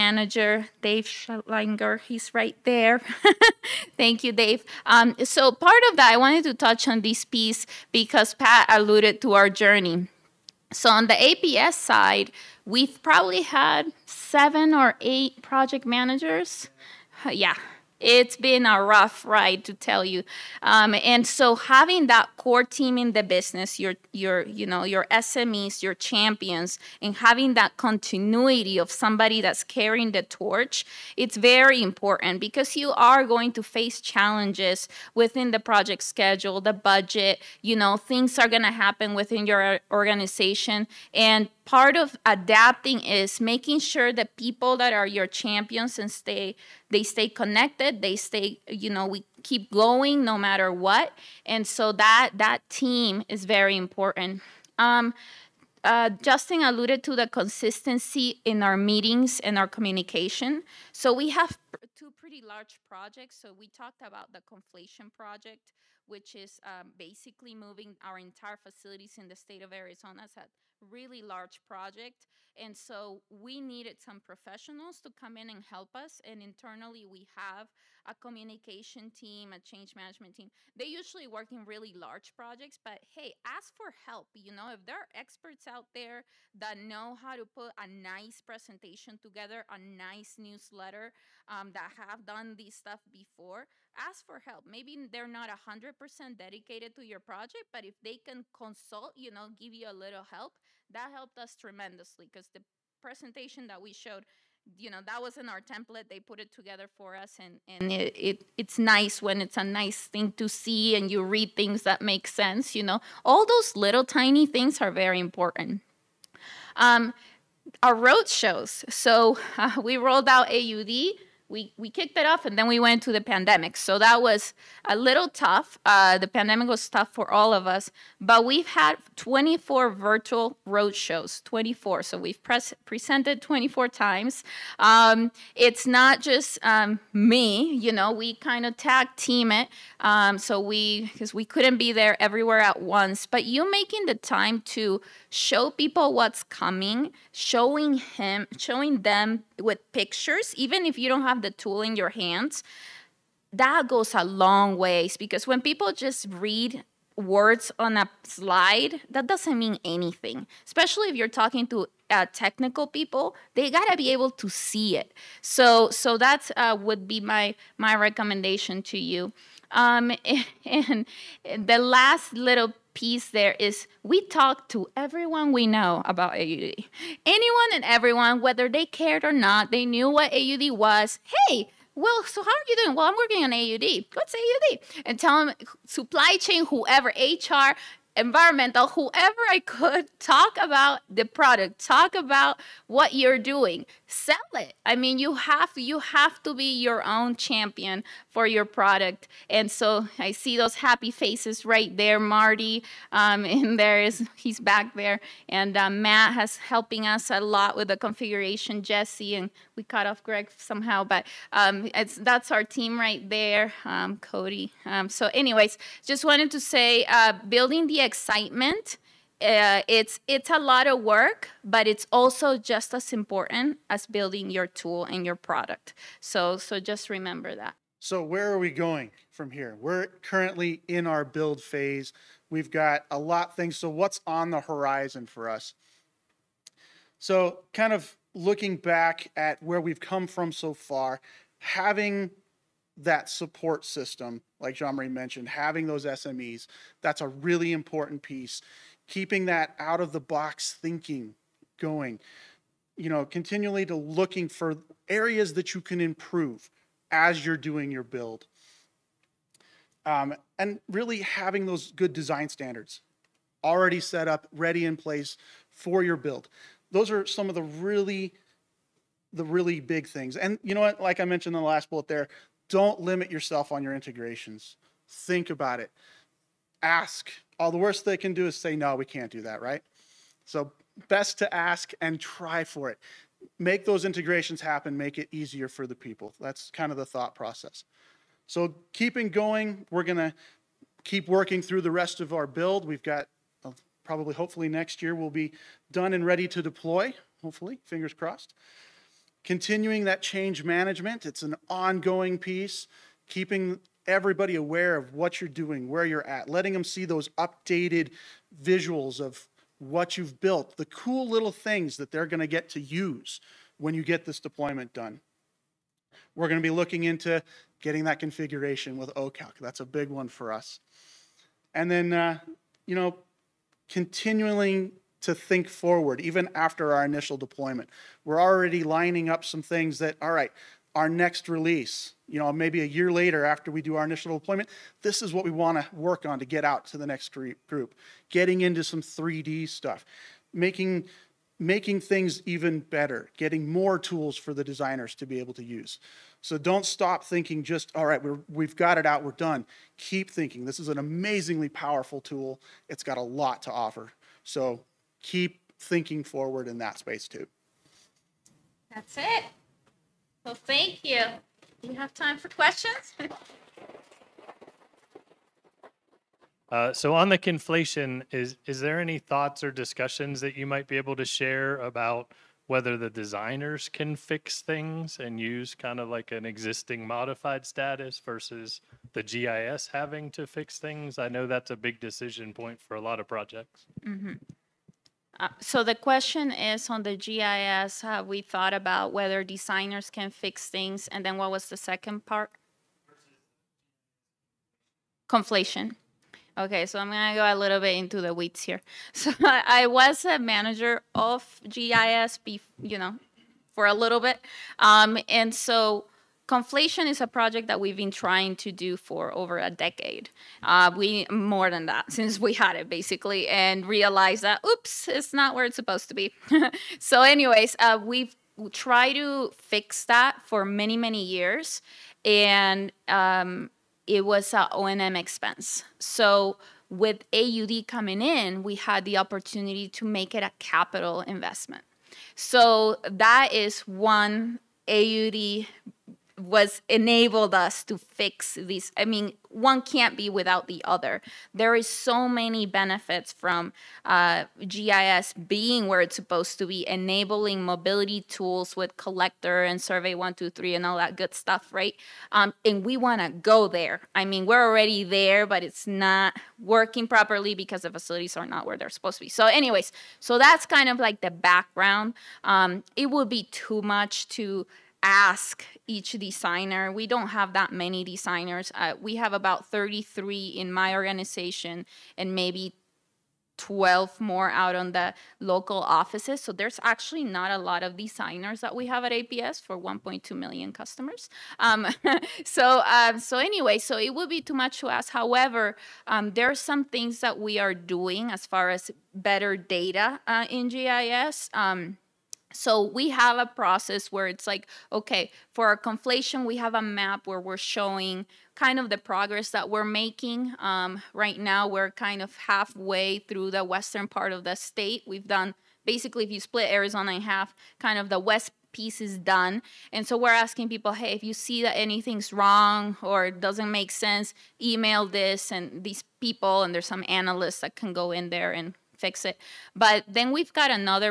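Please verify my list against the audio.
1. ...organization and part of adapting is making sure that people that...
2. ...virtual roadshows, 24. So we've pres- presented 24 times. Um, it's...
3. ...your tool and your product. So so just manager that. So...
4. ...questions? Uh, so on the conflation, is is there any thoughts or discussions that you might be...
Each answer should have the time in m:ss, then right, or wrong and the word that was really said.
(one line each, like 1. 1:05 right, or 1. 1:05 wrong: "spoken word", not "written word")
1. 0:39 right
2. 2:09 right
3. 3:44 wrong: "remember", not "manager"
4. 6:02 right.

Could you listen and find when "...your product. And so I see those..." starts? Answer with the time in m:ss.
3:18.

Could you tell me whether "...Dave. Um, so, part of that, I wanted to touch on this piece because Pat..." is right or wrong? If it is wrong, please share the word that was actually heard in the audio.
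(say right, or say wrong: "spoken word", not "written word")
right.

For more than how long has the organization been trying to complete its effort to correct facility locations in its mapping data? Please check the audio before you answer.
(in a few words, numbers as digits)
a decade.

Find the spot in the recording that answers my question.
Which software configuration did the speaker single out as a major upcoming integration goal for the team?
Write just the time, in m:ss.
5:19.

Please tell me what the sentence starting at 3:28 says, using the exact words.
Jesse and we cut off Greg somehow, but um, it's that's our team right there, um, Cody.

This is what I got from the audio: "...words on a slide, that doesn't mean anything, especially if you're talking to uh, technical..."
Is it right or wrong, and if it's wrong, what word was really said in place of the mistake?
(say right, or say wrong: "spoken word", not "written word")
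right.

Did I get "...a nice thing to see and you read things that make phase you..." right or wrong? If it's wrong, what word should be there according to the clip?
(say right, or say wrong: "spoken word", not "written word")
wrong: "sense", not "phase".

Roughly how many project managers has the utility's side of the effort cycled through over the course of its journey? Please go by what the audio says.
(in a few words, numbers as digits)
7 or 8.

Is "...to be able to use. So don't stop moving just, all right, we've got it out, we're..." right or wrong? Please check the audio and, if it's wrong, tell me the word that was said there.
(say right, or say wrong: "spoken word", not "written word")
wrong: "thinking", not "moving".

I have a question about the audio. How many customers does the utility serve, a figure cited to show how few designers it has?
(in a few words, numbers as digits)
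1.2 million.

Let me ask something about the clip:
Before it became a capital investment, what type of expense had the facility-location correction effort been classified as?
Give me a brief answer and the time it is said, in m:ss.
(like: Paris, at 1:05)
O and M, at 7:04.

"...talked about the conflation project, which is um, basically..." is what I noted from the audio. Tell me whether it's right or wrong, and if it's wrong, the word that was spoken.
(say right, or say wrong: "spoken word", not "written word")
right.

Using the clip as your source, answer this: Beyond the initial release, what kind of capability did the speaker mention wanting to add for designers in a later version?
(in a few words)
3D.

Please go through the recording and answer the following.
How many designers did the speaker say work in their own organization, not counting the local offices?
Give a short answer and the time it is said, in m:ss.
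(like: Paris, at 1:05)
33, at 7:49.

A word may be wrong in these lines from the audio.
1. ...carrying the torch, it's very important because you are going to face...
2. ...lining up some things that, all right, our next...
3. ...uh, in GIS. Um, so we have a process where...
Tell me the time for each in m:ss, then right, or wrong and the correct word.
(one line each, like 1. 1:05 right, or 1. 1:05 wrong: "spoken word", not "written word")
1. 0:29 right
2. 5:28 right
3. 8:10 right.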